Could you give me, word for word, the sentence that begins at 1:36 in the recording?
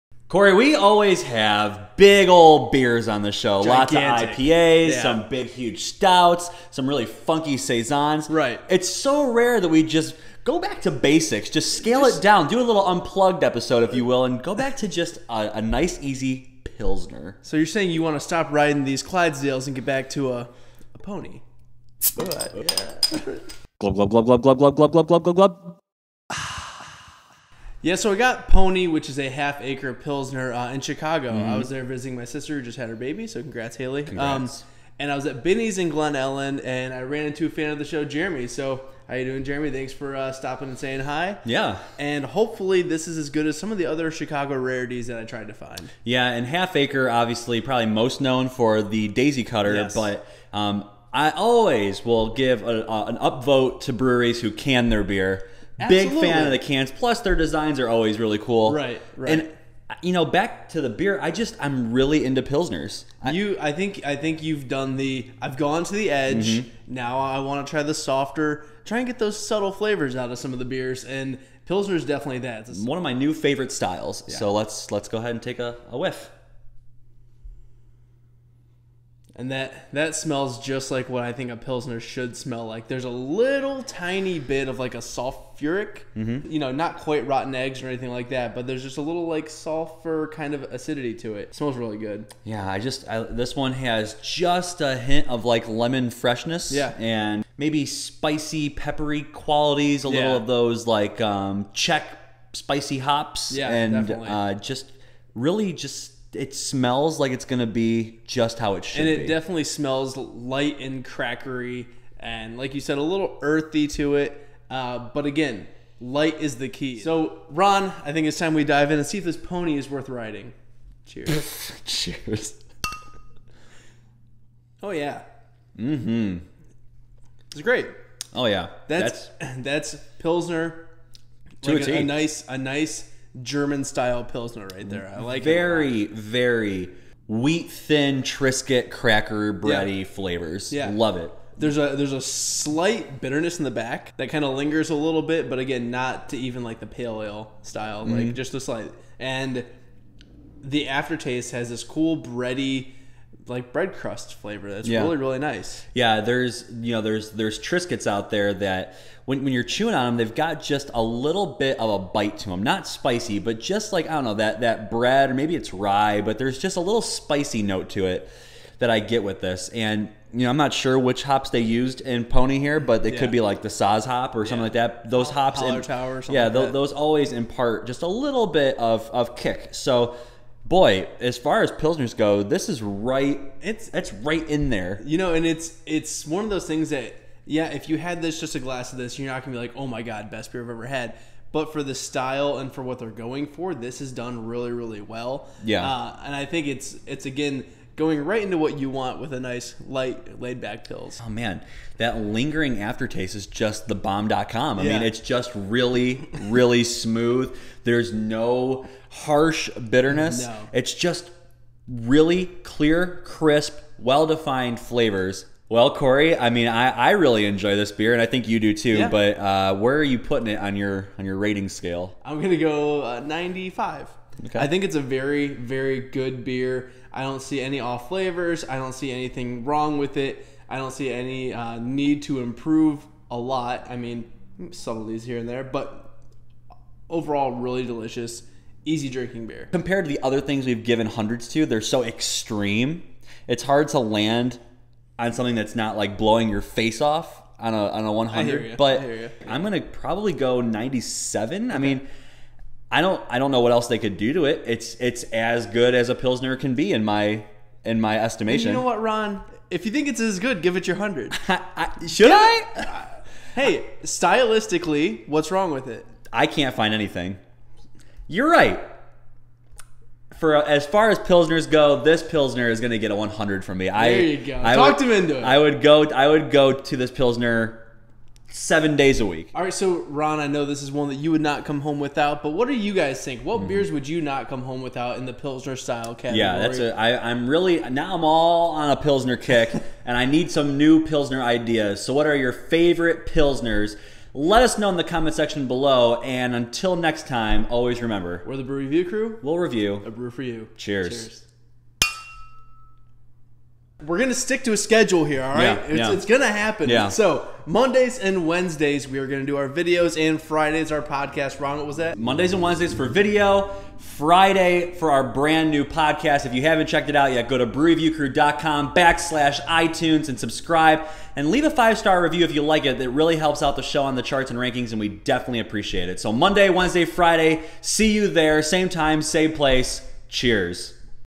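Yeah, and maybe spicy, peppery qualities.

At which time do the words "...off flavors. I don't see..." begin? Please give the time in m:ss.
3:47.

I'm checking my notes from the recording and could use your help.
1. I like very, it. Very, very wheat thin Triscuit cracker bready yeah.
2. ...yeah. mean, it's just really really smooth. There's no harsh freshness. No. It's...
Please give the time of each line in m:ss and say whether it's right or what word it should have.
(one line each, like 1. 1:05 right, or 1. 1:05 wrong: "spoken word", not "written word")
1. 2:15 right
2. 3:24 wrong: "bitterness", not "freshness".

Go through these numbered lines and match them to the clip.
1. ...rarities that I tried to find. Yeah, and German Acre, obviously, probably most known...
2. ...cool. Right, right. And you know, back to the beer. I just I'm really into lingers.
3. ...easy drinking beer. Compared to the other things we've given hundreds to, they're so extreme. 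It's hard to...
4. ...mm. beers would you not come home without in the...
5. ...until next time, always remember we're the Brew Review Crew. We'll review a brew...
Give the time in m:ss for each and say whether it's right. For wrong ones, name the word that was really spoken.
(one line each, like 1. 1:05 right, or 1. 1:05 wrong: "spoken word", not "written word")
1. 0:44 wrong: "Half", not "German"
2. 0:58 wrong: "pilsners", not "lingers"
3. 3:58 right
4. 4:43 right
5. 4:56 right.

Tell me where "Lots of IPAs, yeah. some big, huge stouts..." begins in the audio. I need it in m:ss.
0:03.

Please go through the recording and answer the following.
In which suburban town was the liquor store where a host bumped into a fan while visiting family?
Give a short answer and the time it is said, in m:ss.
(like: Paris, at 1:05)
Glen Ellyn, at 0:35.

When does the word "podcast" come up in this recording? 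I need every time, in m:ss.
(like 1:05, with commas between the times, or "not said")
5:11, 5:15.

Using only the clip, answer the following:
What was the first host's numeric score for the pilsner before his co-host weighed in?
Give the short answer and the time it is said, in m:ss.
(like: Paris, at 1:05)
95, at 3:43.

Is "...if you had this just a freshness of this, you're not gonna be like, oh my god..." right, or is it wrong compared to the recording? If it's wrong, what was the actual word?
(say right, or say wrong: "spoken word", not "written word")
wrong: "glass", not "freshness".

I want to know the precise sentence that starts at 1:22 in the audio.
There's a little tiny bit of like a sulfuric, mm-hmm.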